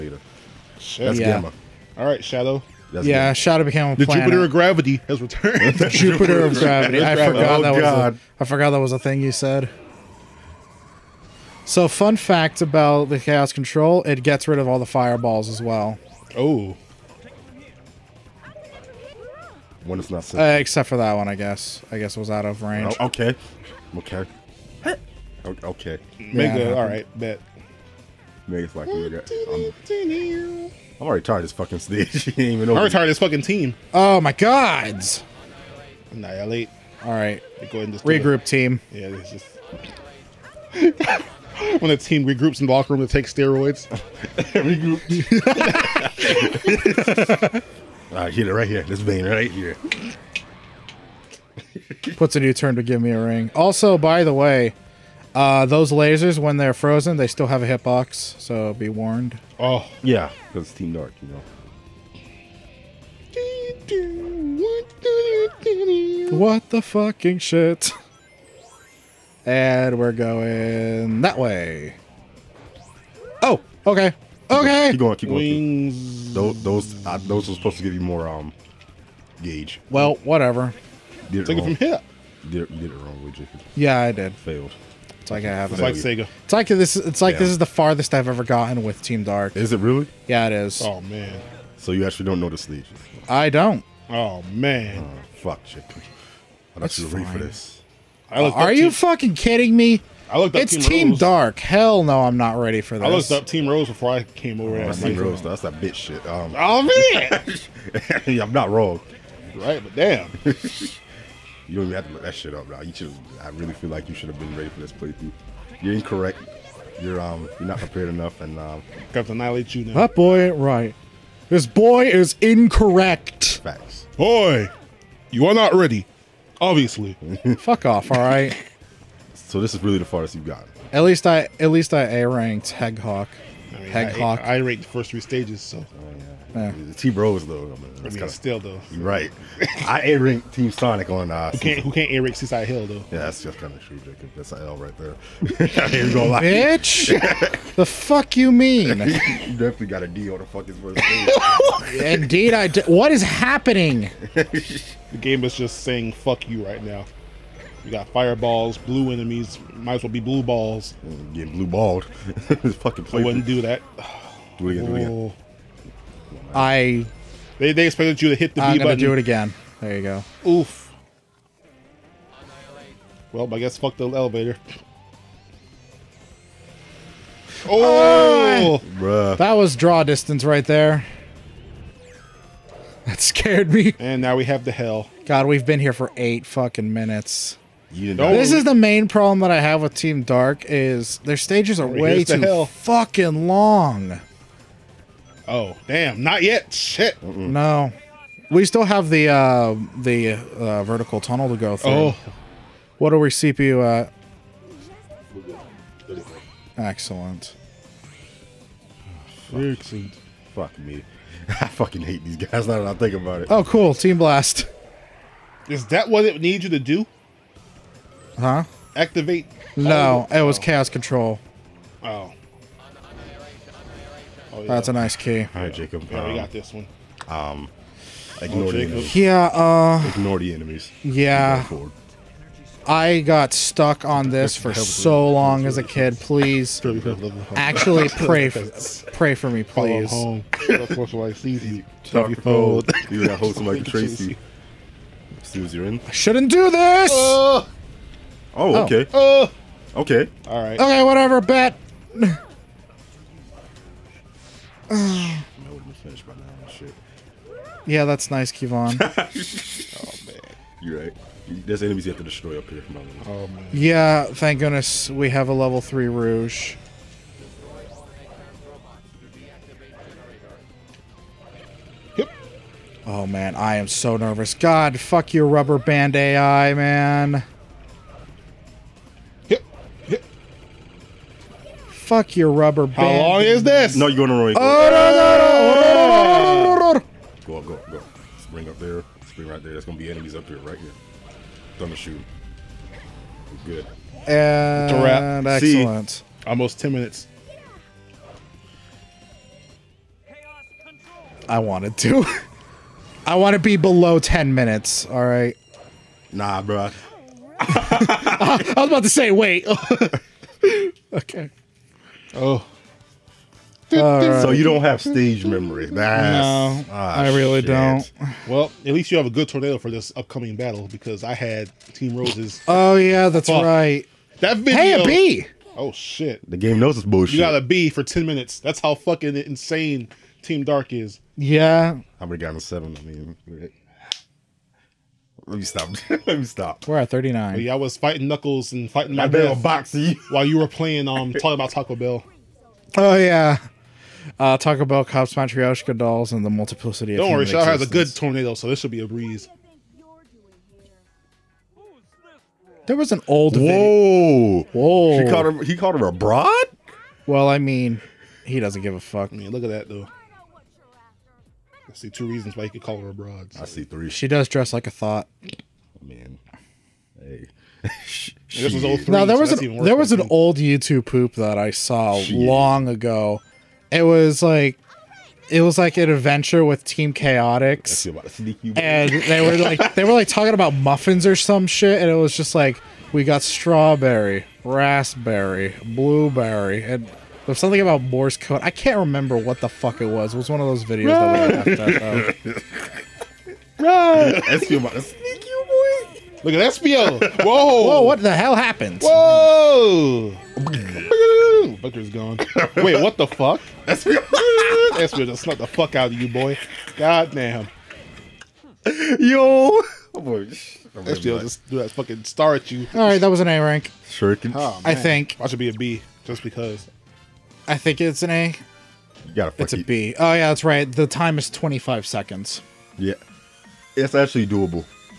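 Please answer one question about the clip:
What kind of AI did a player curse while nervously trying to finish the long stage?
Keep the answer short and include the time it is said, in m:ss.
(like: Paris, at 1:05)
rubber band AI, at 4:35.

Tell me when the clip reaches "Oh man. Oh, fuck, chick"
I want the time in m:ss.
1:34.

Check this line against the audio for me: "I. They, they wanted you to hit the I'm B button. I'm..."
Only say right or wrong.
wrong.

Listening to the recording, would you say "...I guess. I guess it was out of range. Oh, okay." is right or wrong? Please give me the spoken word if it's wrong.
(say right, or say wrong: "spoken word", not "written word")
right.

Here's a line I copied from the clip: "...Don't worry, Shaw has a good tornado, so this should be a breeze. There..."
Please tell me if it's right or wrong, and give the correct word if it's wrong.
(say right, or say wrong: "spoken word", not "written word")
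right.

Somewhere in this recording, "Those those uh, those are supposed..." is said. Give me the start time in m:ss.
1:16.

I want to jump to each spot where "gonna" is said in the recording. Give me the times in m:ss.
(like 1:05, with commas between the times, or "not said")
2:26, 2:48.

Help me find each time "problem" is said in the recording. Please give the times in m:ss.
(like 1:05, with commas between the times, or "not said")
3:09.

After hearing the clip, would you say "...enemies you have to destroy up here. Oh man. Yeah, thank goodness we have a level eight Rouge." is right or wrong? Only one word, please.
wrong.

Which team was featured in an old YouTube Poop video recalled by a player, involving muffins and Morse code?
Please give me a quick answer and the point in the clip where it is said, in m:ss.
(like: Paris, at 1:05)
Team Chaotix, at 6:16.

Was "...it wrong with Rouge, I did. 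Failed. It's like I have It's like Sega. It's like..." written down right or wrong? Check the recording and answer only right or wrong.
wrong.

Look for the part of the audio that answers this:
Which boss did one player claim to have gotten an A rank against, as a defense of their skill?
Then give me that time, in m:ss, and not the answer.
2:12.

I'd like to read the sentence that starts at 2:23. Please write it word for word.
Yeah, that's just kind of true, Jacob.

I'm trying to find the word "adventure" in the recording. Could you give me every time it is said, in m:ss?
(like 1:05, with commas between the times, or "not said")
6:16.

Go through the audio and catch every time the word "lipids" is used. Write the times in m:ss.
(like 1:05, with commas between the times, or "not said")
not said.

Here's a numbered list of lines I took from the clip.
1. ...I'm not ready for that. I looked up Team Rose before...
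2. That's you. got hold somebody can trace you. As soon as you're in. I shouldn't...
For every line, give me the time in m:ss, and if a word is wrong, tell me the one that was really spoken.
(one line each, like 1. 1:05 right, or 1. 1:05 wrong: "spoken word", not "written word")
1. 1:42 right
2. 4:00 right.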